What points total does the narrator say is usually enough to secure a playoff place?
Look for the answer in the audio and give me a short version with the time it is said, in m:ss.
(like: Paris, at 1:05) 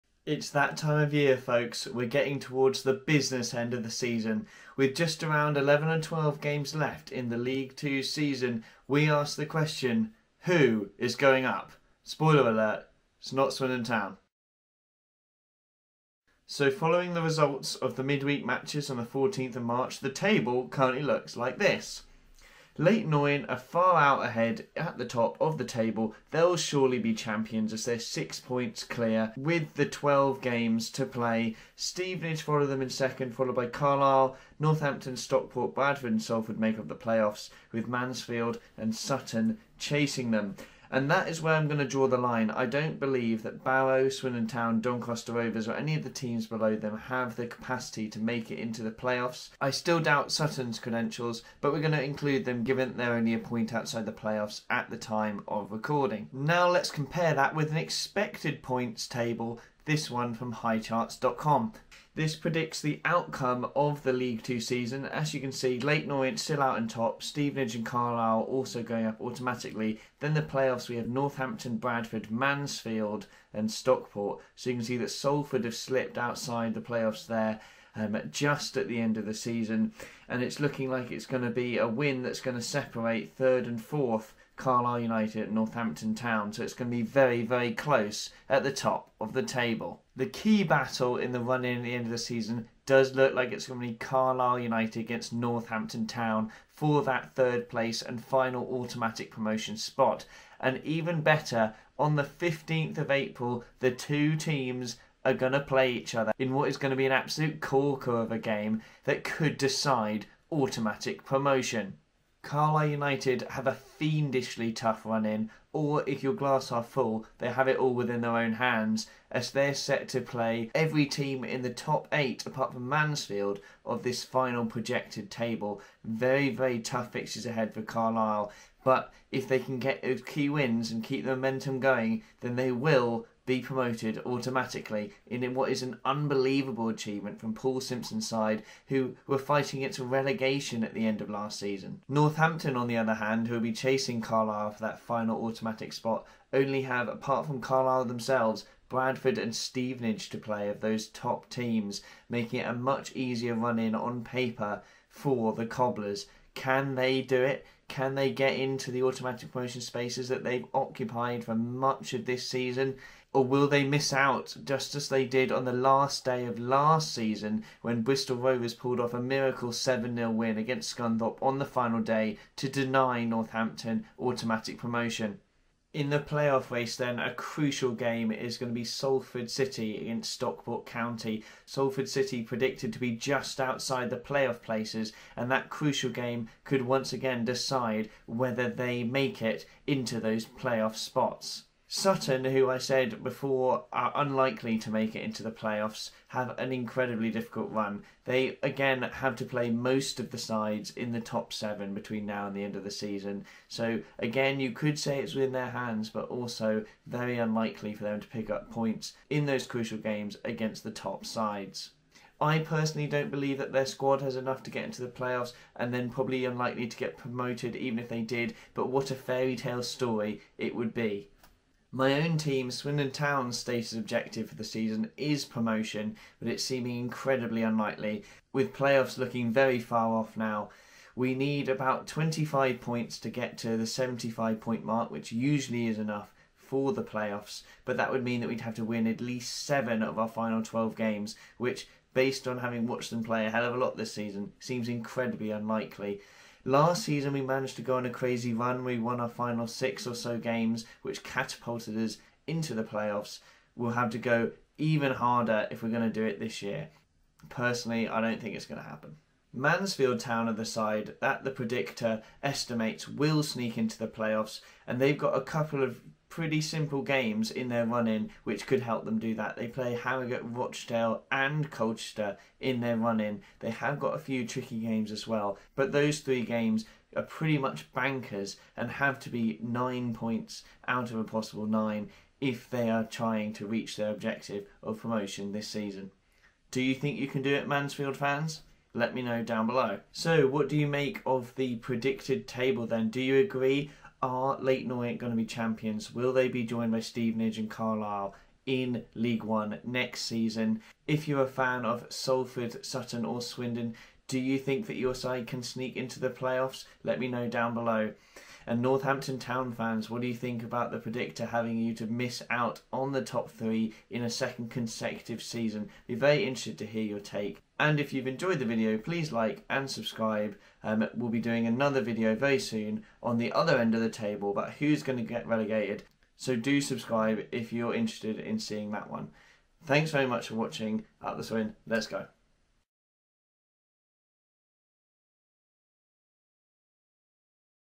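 75, at 3:53.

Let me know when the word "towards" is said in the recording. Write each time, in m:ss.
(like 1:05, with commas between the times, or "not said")
0:02.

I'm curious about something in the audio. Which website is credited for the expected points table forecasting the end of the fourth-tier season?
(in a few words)
highcharts.com.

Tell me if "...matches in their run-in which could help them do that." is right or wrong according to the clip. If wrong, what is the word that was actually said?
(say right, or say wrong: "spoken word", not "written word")
wrong: "games", not "matches".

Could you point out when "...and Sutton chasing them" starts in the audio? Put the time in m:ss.
0:38.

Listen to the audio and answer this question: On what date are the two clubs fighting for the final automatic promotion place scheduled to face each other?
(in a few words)
15th of April.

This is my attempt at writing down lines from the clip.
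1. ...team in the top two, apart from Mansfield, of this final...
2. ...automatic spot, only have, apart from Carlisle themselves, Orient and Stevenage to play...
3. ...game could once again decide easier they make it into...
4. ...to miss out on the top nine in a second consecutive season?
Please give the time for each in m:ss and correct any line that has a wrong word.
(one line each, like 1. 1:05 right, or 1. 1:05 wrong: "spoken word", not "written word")
1. 2:01 wrong: "eight", not "two"
2. 2:25 wrong: "Bradford", not "Orient"
3. 3:06 wrong: "whether", not "easier"
4. 5:11 wrong: "three", not "nine".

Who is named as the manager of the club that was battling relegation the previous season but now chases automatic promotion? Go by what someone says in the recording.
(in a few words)
Paul Simpson.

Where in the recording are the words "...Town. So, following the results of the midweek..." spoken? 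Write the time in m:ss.
0:13.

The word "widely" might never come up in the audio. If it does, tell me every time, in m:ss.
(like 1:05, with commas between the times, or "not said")
not said.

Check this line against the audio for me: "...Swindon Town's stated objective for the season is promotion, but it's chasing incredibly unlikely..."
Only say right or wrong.
wrong.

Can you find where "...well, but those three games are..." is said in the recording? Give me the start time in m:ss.
4:35.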